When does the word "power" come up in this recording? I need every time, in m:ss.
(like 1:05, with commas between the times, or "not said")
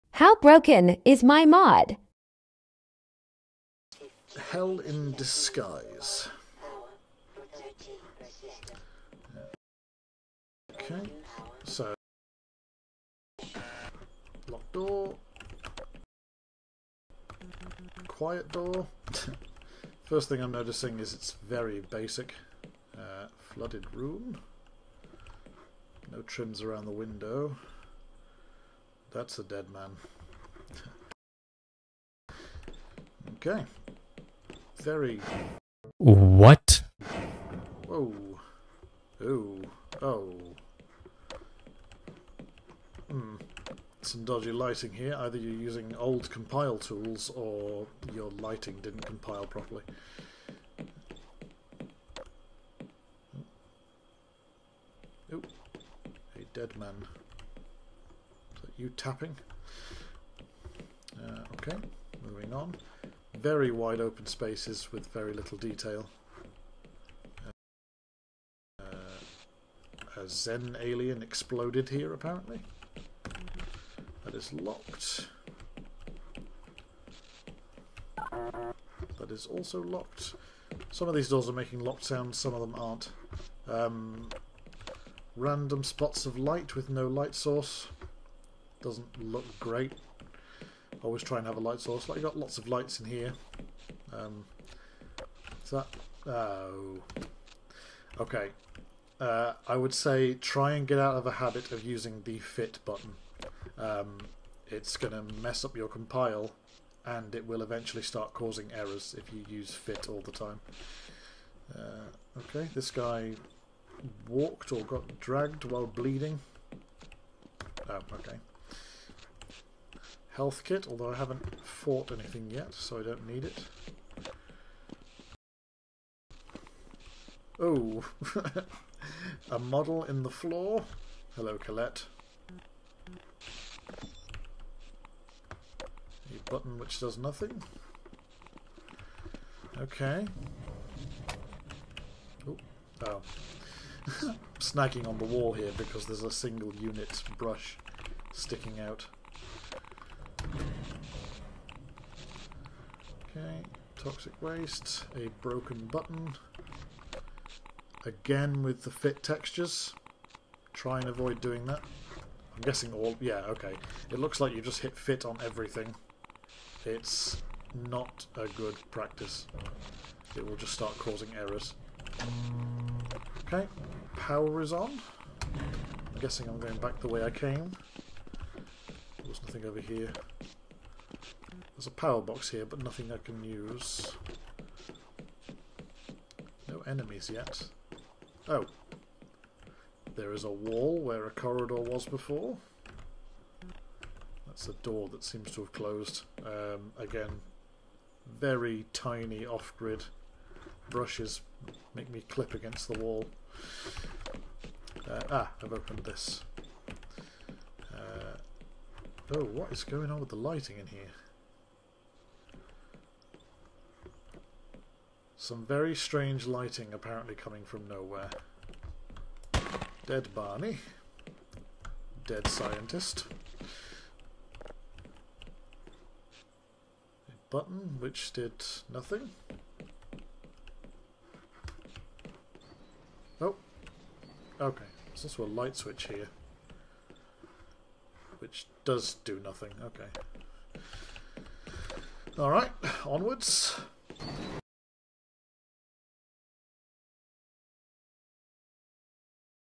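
2:54, 3:01.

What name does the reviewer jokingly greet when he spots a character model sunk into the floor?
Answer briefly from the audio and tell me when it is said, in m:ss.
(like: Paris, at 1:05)
Colette, at 2:11.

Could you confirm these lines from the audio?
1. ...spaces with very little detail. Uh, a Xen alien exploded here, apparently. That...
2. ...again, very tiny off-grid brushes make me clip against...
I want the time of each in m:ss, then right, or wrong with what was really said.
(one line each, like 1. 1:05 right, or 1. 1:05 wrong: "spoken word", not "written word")
1. 1:04 right
2. 3:16 right.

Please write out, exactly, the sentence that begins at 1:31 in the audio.
always try and have a light source.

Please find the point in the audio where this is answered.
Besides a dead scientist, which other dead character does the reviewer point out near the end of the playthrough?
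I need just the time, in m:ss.
3:40.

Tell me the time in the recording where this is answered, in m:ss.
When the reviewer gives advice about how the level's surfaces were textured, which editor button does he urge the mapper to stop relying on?
1:42.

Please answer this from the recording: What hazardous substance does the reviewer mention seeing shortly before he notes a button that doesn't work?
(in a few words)
toxic waste.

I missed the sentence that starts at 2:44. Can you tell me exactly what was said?
It looks like you just hit fit on everything.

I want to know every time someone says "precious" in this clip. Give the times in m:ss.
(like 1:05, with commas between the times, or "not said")
not said.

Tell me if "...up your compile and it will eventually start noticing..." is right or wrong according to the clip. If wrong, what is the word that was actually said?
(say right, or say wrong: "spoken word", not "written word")
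wrong: "causing", not "noticing".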